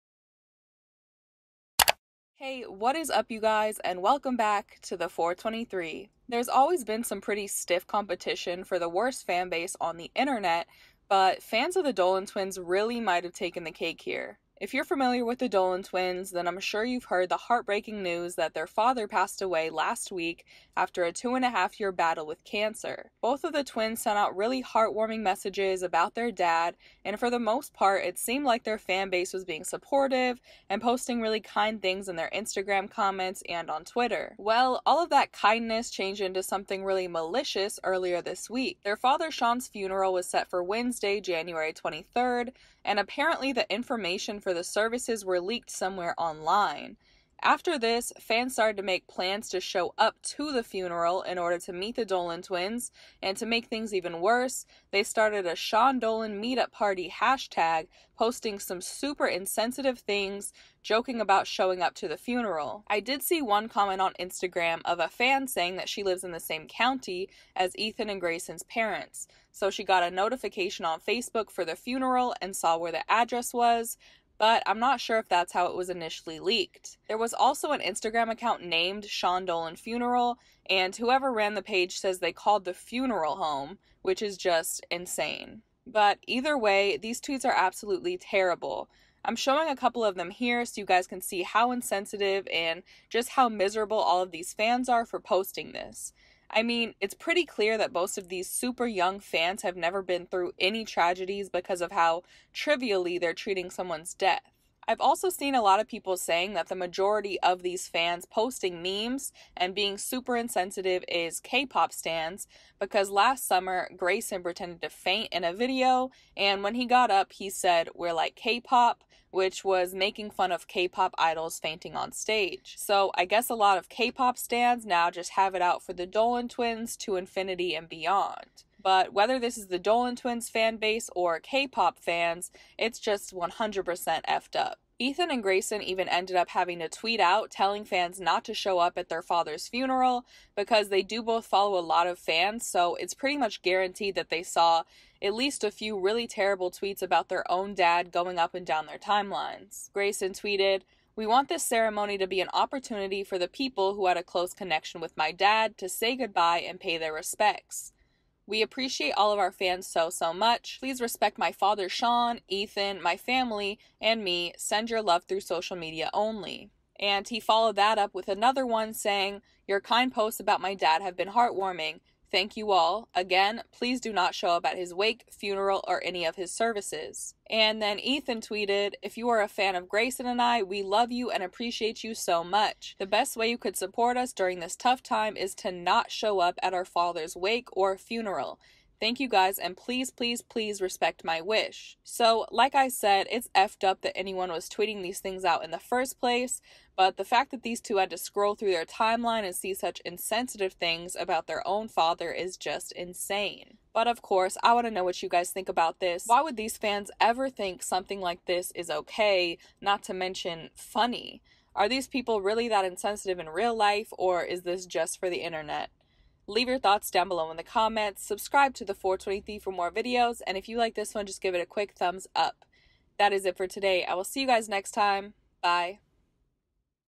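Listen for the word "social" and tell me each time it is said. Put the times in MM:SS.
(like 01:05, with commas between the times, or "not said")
02:45.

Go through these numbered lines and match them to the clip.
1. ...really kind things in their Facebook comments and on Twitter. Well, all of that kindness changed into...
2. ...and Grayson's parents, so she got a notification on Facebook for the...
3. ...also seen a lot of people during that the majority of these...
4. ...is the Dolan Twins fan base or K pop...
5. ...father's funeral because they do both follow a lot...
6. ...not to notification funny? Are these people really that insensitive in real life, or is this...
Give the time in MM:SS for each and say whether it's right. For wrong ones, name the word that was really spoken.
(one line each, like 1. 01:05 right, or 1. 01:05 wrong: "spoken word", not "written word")
1. 00:31 wrong: "Instagram", not "Facebook"
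2. 01:08 right
3. 01:45 wrong: "saying", not "during"
4. 02:09 right
5. 02:19 right
6. 03:29 wrong: "mention", not "notification".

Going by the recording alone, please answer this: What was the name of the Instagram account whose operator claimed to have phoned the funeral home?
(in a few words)
Sean Dolan Funeral.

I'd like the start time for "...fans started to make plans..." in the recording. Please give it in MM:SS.
00:48.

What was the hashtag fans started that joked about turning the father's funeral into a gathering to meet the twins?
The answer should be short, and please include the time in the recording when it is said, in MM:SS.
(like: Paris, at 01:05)
Sean Dolan meetup party, at 00:55.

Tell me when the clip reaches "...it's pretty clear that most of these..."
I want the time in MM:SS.
01:36.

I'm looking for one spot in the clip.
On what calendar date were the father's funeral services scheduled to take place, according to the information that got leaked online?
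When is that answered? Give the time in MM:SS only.
00:41.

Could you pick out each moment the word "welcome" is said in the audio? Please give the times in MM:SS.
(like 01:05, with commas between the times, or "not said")
00:04.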